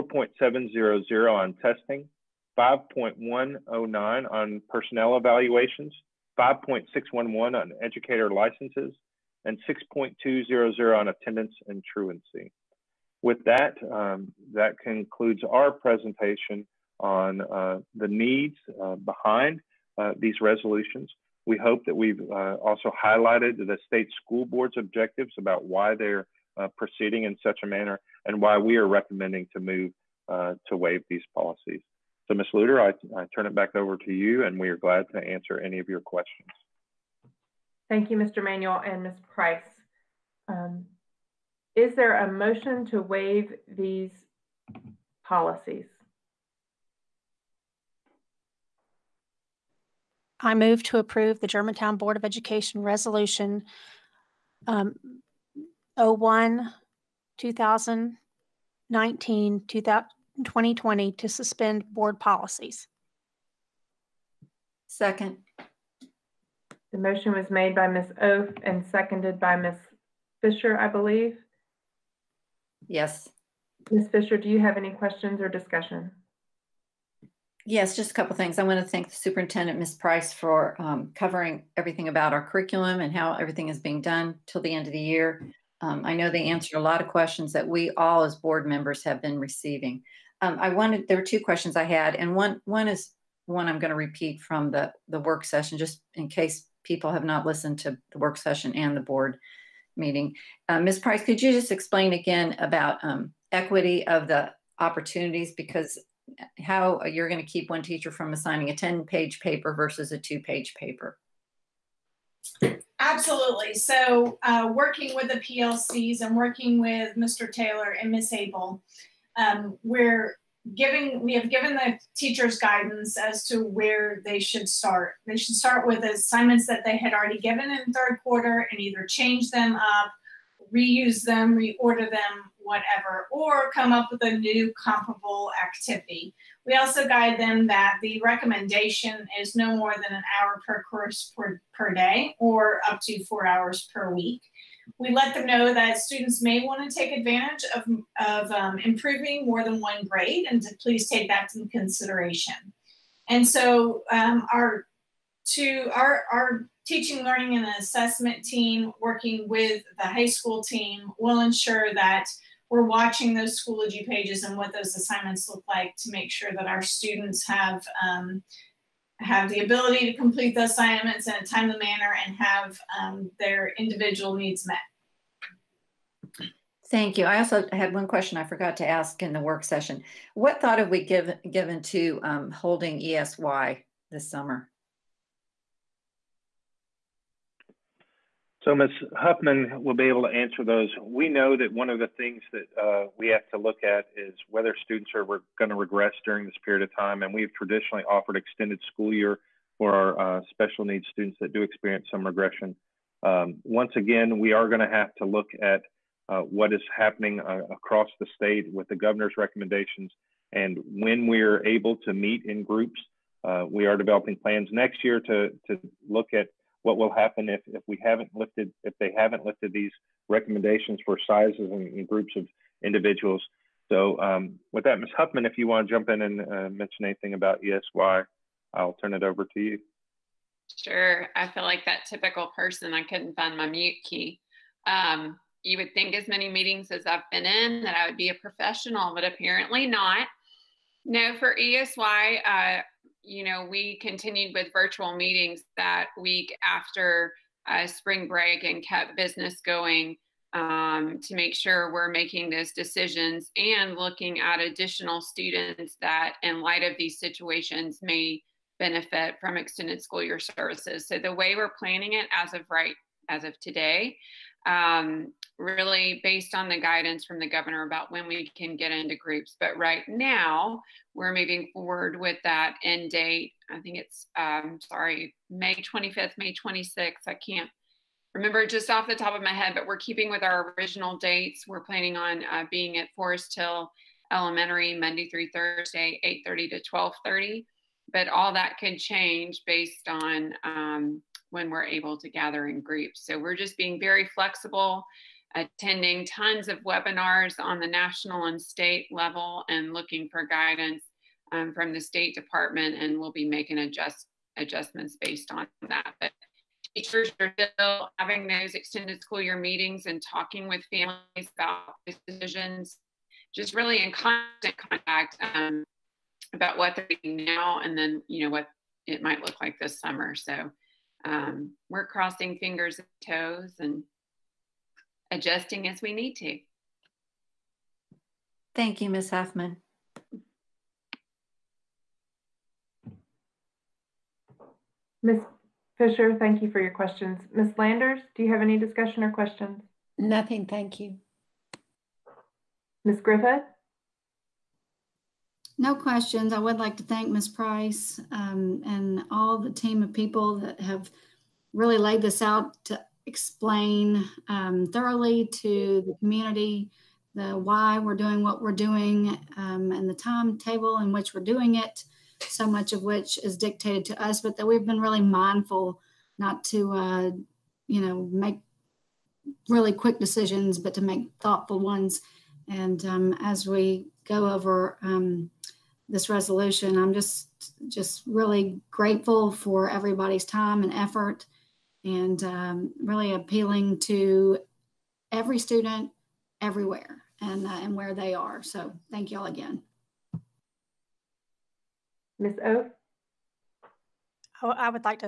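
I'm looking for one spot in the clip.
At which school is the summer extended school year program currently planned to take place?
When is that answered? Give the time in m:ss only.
4:43.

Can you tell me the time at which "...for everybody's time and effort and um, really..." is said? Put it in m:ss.
6:19.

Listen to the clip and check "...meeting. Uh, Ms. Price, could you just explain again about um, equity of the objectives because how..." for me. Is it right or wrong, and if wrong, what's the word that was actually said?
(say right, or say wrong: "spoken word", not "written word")
wrong: "opportunities", not "objectives".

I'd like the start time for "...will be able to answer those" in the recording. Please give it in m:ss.
3:09.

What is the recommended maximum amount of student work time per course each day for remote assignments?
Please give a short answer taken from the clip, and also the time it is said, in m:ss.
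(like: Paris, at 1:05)
an hour, at 2:20.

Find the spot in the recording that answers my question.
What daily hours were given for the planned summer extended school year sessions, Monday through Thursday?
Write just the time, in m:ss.
4:46.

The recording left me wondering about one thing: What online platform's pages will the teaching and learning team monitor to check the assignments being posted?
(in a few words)
Schoology.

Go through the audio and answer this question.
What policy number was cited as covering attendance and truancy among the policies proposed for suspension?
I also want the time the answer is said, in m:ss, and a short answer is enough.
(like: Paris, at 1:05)
6.200, at 0:09.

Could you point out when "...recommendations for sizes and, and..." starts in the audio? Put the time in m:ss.
3:40.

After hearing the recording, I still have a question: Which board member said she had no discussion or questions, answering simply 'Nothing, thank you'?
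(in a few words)
Ms. Landers.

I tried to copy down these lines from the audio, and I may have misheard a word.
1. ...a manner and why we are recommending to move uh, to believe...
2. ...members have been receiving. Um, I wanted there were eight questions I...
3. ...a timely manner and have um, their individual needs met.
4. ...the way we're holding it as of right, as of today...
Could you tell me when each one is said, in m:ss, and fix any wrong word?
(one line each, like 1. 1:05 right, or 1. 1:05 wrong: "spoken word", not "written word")
1. 0:27 wrong: "waive", not "believe"
2. 1:28 wrong: "two", not "eight"
3. 2:51 right
4. 4:21 wrong: "planning", not "holding".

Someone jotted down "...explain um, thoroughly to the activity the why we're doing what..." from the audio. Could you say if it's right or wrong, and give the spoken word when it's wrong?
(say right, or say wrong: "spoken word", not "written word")
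wrong: "community", not "activity".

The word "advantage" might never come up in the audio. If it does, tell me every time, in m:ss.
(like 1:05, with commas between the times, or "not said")
2:27.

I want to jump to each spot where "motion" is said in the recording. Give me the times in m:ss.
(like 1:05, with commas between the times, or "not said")
0:42, 1:06.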